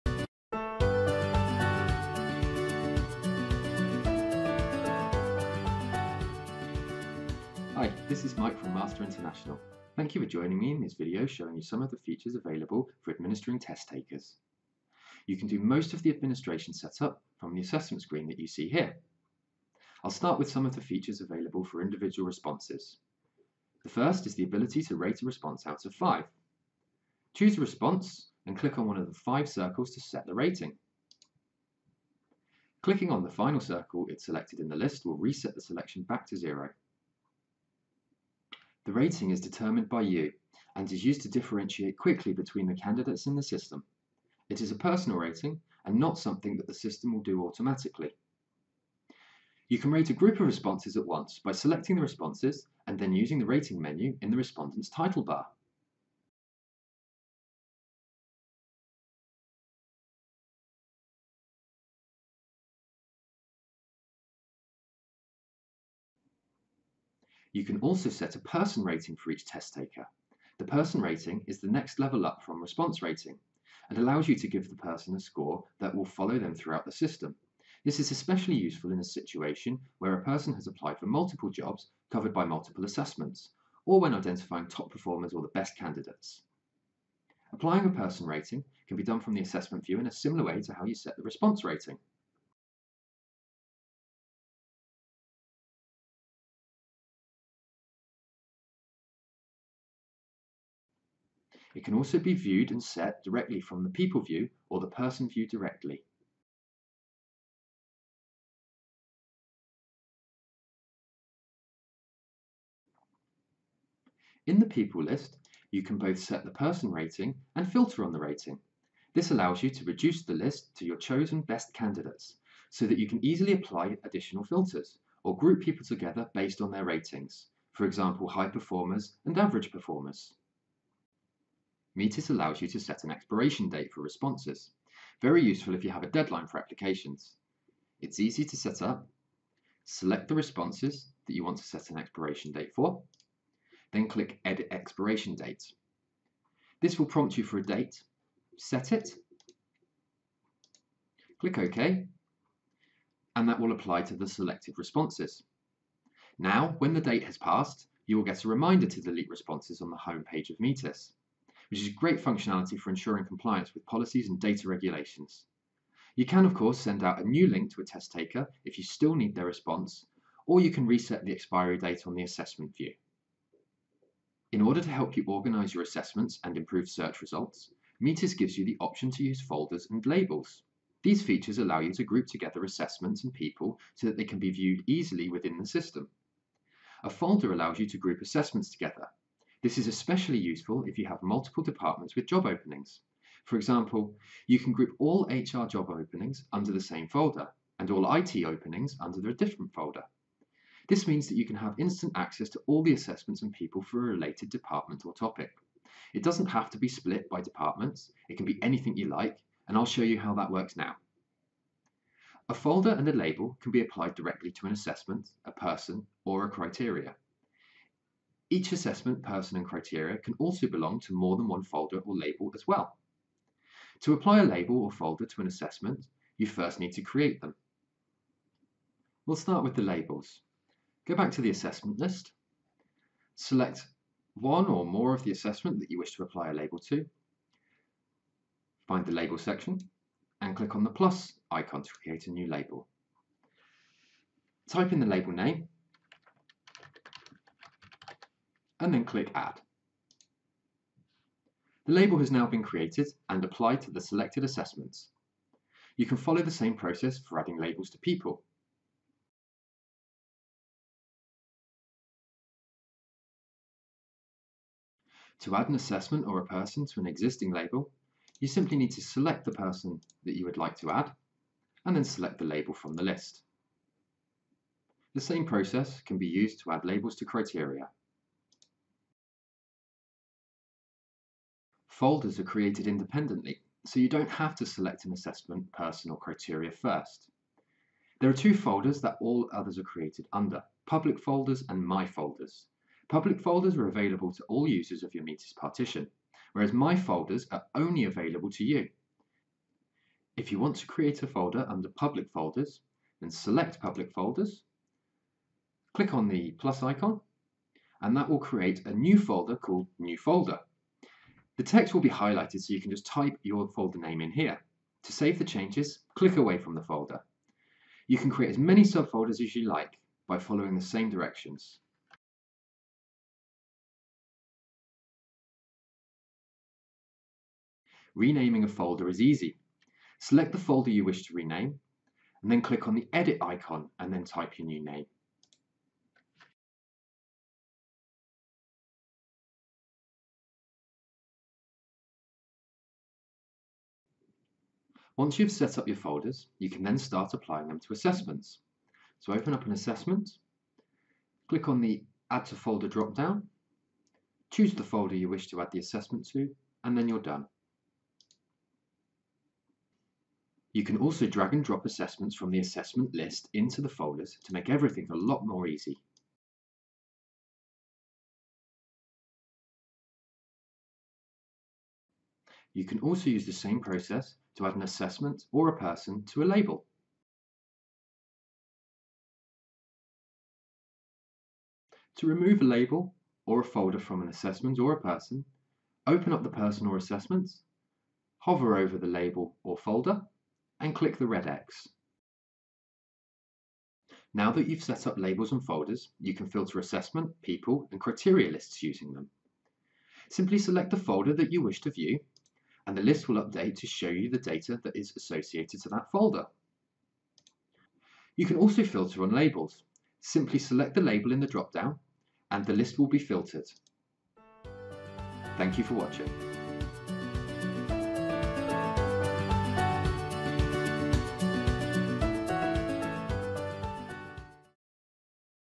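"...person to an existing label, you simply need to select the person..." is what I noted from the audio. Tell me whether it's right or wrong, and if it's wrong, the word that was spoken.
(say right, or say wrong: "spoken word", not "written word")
right.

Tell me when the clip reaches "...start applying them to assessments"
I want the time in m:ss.
5:46.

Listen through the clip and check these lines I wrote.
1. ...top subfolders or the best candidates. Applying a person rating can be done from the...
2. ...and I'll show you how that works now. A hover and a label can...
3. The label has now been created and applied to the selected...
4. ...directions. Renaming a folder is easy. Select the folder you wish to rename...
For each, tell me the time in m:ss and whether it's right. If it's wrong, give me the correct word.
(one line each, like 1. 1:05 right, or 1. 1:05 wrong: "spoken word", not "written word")
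1. 1:24 wrong: "performers", not "subfolders"
2. 3:29 wrong: "folder", not "hover"
3. 4:11 right
4. 5:21 right.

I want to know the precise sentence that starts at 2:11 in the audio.
Metis allows you to set an expiration date for responses.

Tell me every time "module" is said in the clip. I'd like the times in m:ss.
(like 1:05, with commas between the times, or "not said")
not said.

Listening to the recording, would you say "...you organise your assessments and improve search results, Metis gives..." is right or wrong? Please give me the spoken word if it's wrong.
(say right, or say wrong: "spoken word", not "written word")
right.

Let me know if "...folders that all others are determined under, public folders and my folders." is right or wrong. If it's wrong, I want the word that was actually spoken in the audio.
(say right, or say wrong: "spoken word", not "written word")
wrong: "created", not "determined".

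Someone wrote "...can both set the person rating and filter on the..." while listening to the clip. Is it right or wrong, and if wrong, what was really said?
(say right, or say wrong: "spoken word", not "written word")
right.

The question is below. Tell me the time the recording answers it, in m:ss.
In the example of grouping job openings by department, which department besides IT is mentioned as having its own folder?
3:15.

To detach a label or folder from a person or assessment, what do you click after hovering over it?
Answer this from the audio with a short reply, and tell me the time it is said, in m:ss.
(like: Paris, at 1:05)
the red X, at 6:31.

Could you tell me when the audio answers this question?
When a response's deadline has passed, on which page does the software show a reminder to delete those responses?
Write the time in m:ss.
2:39.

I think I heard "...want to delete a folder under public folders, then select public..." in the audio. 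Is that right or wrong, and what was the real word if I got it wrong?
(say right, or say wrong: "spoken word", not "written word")
wrong: "create", not "delete".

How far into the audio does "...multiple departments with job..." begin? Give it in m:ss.
3:11.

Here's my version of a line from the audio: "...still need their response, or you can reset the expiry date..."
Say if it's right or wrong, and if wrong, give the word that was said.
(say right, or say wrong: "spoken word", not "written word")
right.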